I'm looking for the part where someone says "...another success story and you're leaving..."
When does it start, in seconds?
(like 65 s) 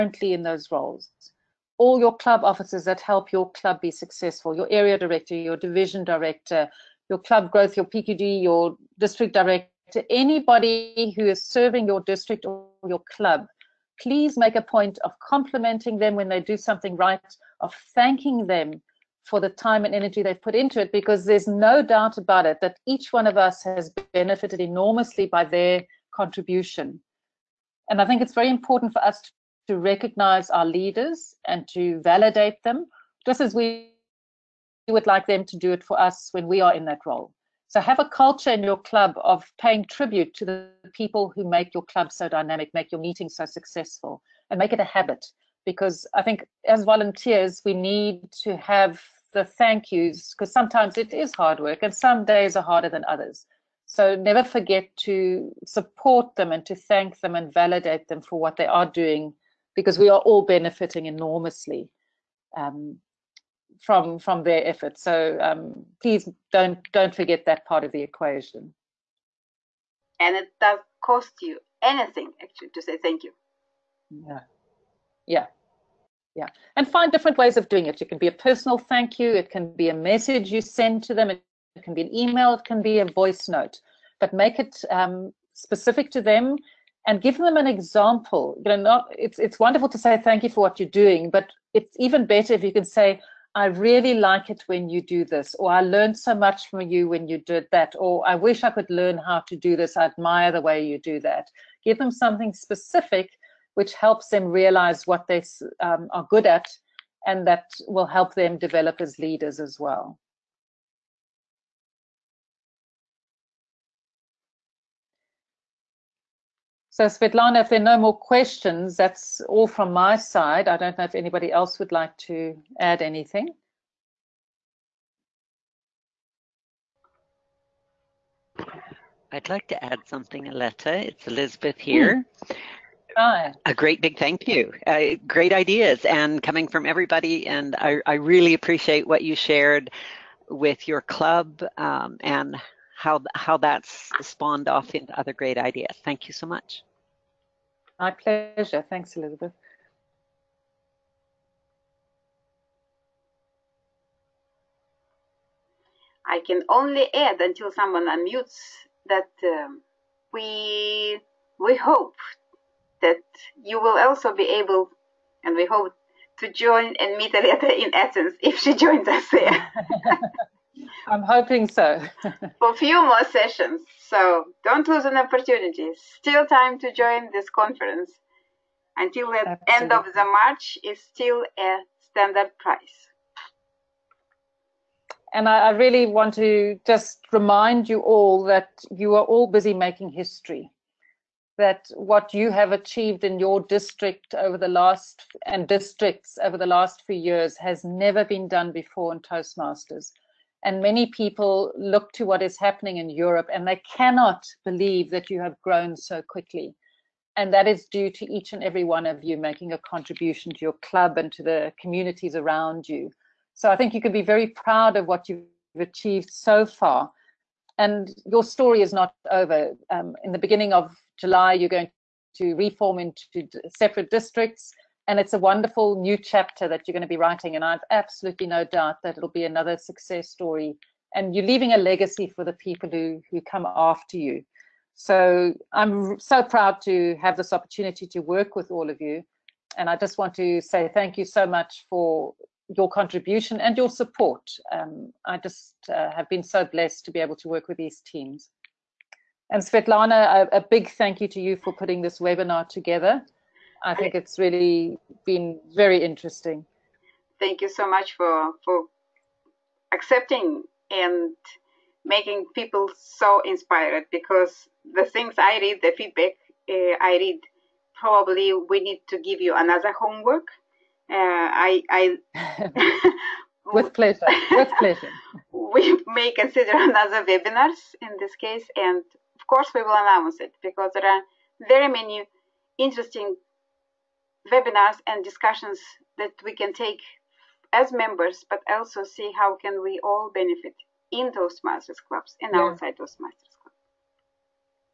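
229 s.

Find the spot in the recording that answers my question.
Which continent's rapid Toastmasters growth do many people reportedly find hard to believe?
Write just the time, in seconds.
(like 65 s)
203 s.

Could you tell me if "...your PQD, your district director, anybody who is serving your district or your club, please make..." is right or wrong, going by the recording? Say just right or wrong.
right.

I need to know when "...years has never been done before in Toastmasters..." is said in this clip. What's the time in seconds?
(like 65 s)
197 s.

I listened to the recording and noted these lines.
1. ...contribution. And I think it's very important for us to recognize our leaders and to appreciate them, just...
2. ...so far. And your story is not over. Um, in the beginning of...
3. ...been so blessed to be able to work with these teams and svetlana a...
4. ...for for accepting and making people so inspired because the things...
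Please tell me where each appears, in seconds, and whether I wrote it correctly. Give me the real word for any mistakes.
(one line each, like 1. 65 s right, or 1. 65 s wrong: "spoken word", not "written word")
1. 26 s wrong: "validate", not "appreciate"
2. 216 s right
3. 246 s right
4. 258 s right.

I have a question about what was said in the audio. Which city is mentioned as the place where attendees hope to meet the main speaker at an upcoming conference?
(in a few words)
Athens.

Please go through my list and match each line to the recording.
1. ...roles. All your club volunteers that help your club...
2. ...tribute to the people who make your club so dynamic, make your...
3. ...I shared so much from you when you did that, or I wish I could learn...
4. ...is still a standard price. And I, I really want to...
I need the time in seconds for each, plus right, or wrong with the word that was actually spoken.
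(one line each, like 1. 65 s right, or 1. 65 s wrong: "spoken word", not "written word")
1. 0 s wrong: "officers", not "volunteers"
2. 39 s right
3. 95 s wrong: "learned", not "shared"
4. 180 s right.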